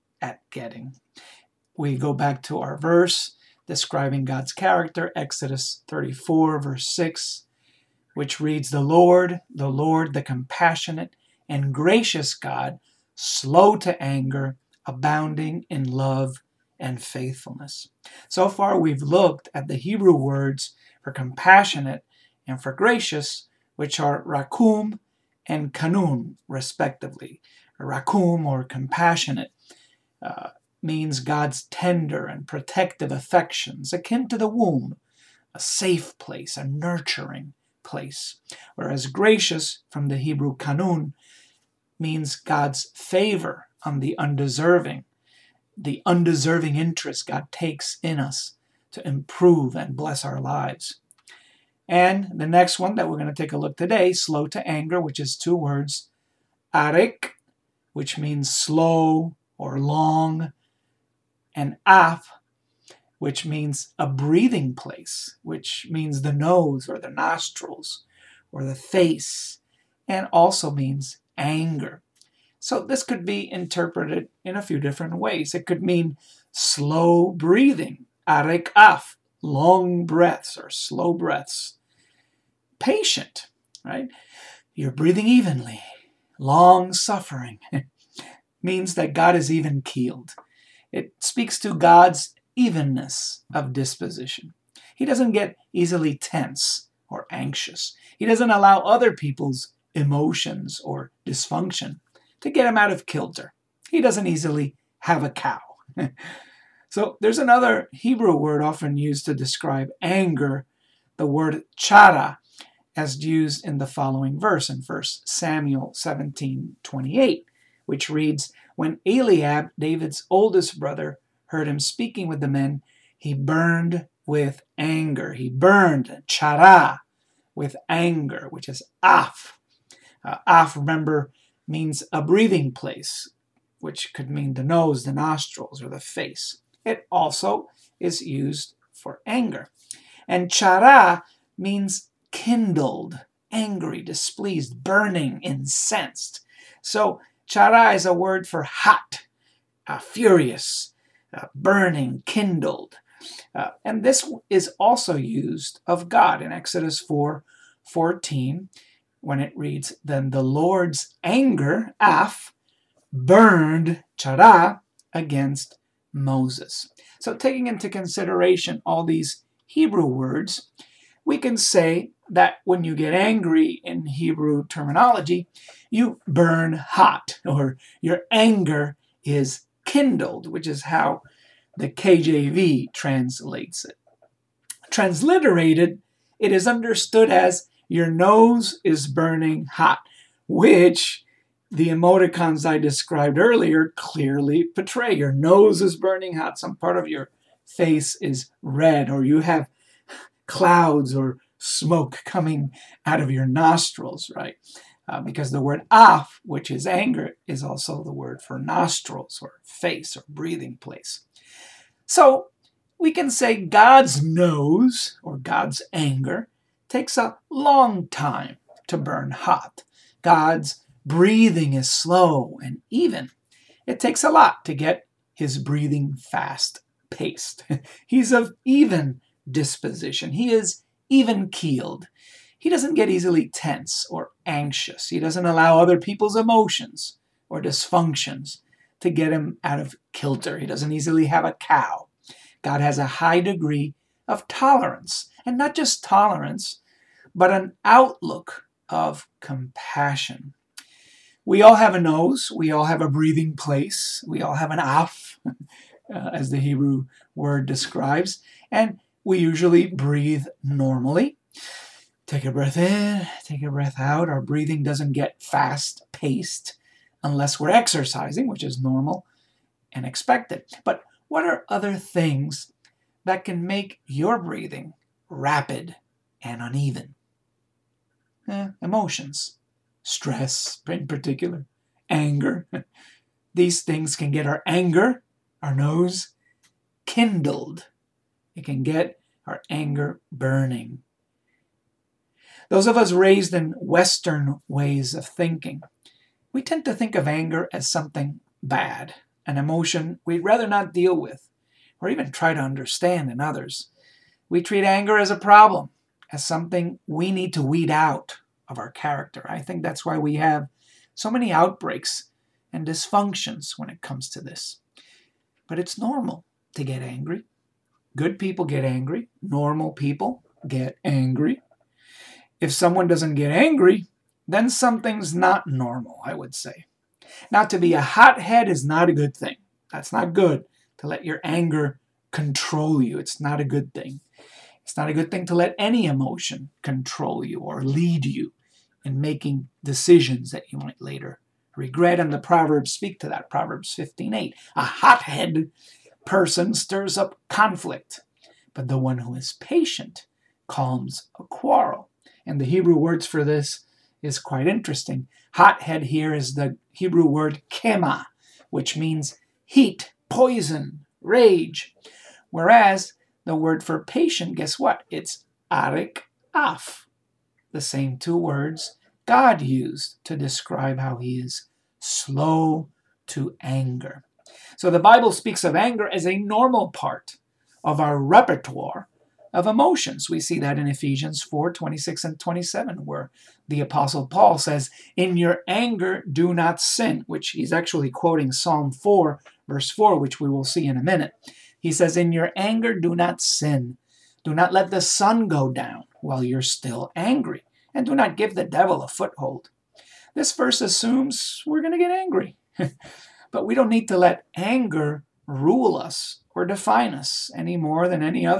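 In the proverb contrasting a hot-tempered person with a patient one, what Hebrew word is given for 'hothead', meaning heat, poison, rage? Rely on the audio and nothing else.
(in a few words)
kema.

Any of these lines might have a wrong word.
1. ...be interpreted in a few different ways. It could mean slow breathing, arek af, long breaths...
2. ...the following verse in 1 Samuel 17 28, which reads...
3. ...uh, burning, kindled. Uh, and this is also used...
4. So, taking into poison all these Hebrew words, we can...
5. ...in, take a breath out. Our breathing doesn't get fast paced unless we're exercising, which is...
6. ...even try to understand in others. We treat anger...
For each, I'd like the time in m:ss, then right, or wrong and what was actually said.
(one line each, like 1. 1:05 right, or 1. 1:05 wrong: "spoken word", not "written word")
1. 1:13 right
2. 1:53 right
3. 2:31 right
4. 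2:47 wrong: "consideration", not "poison"
5. 4:22 right
6. 5:02 right.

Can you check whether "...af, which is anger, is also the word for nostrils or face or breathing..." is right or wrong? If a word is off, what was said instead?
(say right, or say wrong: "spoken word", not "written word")
right.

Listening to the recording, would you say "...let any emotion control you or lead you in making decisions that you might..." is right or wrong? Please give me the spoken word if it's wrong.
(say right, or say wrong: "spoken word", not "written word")
right.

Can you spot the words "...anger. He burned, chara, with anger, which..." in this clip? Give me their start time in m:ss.
2:04.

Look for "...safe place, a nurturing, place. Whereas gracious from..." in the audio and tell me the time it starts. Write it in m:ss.
0:35.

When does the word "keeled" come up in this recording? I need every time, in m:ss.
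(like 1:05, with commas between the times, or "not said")
1:29, 3:51.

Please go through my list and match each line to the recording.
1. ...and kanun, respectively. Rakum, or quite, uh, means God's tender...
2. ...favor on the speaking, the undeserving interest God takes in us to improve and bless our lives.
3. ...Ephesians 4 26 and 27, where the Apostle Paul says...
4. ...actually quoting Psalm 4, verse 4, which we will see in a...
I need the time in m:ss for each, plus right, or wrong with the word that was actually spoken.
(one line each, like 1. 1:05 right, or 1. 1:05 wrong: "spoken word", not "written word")
1. 0:25 wrong: "compassionate", not "quite"
2. 0:42 wrong: "undeserving", not "speaking"
3. 6:20 right
4. 6:27 right.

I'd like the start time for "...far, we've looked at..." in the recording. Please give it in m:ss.
0:18.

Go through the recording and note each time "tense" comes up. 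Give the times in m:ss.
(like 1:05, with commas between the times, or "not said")
1:36, 3:53.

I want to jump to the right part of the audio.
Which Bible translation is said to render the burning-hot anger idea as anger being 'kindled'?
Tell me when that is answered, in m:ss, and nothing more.
3:01.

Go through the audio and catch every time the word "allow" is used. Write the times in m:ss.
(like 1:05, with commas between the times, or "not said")
1:38, 3:55.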